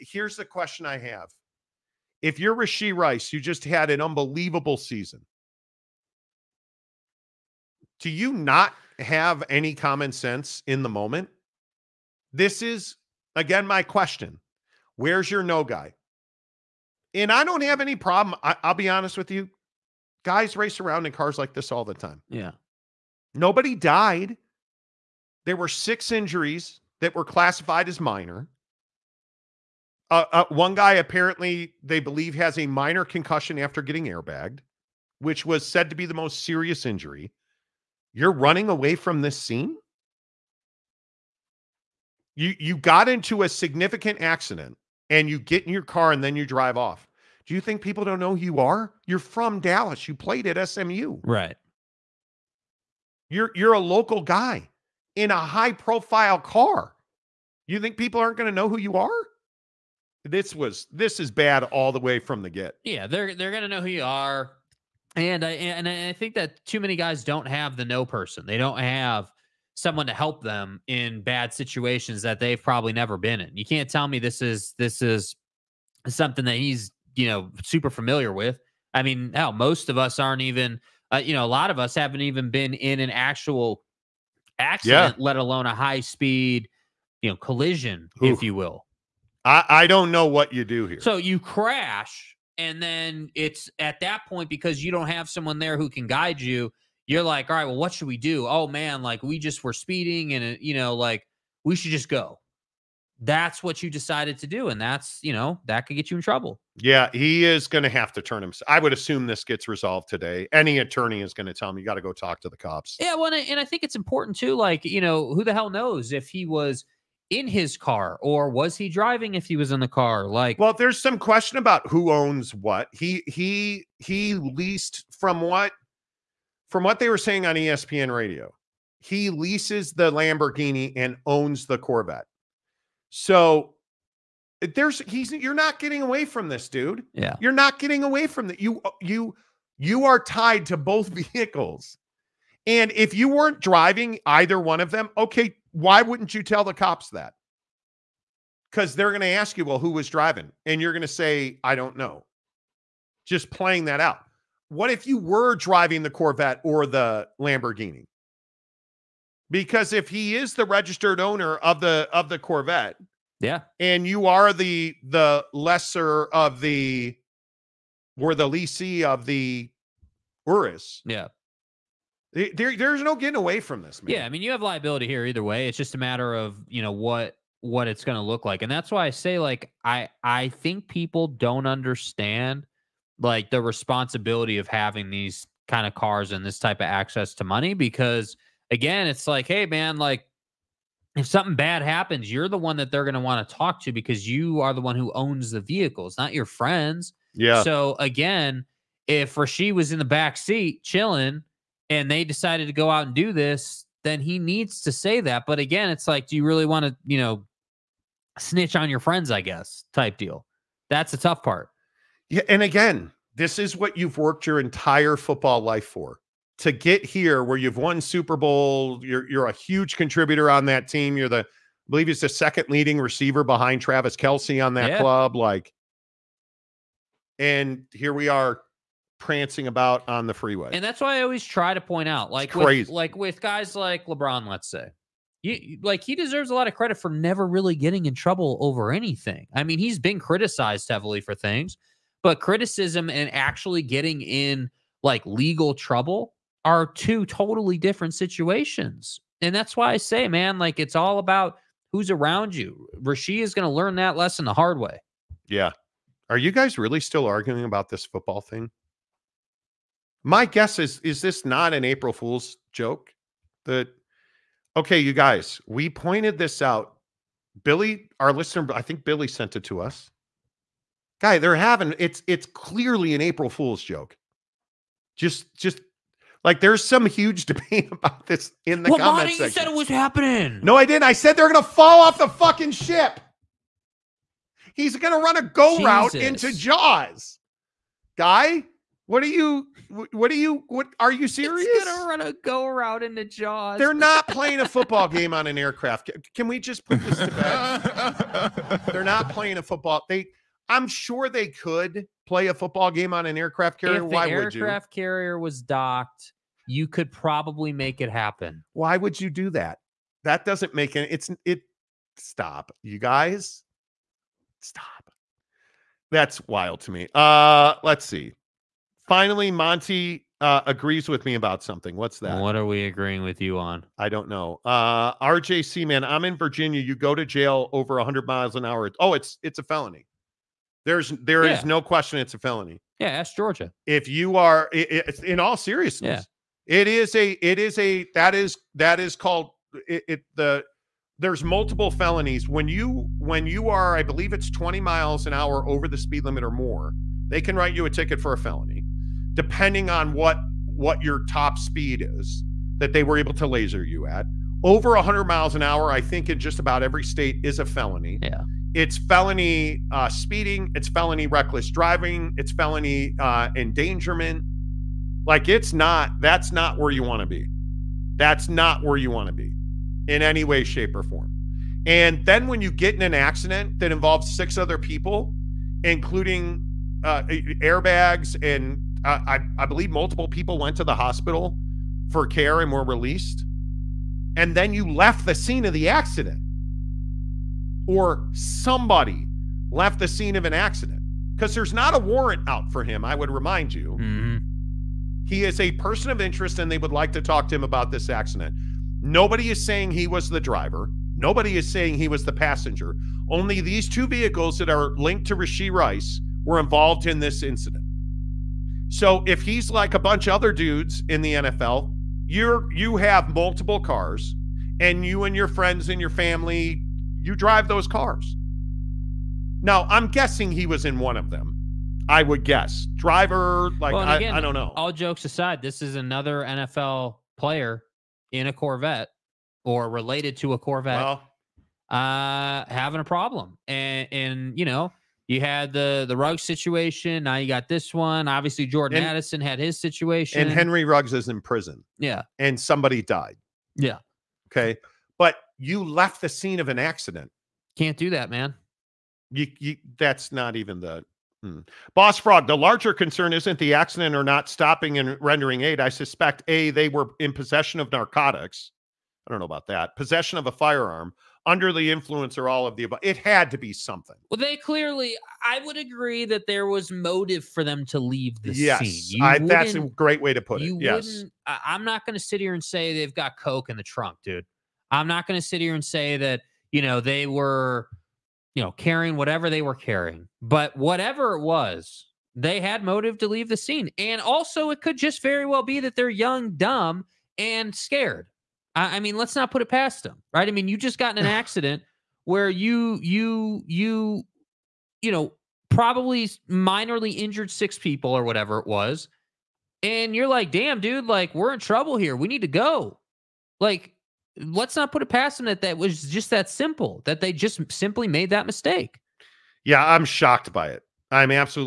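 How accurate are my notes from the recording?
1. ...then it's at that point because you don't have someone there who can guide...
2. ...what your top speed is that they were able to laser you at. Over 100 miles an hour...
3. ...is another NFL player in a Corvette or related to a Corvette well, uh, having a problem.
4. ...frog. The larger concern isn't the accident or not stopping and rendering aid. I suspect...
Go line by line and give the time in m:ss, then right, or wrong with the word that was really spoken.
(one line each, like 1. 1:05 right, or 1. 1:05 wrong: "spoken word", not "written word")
1. 1:32 right
2. 5:50 right
3. 7:05 right
4. 7:32 right.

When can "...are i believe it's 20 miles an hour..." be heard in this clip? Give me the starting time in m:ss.
5:43.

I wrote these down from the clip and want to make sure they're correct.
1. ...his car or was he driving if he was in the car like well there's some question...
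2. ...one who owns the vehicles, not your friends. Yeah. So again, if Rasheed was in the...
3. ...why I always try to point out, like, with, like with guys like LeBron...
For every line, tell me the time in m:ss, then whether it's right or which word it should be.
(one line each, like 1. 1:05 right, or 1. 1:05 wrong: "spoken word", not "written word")
1. 1:57 right
2. 3:14 right
3. 3:50 right.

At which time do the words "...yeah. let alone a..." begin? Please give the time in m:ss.
1:25.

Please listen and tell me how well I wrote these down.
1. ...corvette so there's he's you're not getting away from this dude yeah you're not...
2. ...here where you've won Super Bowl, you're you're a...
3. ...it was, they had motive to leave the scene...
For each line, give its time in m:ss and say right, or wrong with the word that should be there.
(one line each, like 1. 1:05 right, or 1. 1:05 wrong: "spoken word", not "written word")
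1. 2:11 right
2. 3:37 right
3. 8:01 right.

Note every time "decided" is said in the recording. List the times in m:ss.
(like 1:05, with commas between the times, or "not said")
1:43, 3:22.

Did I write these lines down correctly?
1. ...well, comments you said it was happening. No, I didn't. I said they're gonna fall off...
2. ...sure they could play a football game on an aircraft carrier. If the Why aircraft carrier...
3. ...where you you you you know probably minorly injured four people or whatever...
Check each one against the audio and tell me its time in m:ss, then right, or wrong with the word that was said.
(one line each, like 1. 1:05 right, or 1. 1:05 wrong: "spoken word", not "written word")
1. 4:38 right
2. 5:00 right
3. 8:12 wrong: "six", not "four".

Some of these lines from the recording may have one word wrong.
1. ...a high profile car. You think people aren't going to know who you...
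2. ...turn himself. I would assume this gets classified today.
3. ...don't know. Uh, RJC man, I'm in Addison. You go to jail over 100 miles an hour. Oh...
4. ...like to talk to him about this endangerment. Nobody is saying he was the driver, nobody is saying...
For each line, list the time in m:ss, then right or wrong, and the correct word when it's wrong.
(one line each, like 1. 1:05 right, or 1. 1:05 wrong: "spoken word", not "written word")
1. 0:55 right
2. 1:48 wrong: "resolved", not "classified"
3. 5:24 wrong: "Virginia", not "Addison"
4. 6:36 wrong: "accident", not "endangerment".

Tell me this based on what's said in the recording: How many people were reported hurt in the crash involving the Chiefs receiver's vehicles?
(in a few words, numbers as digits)
6.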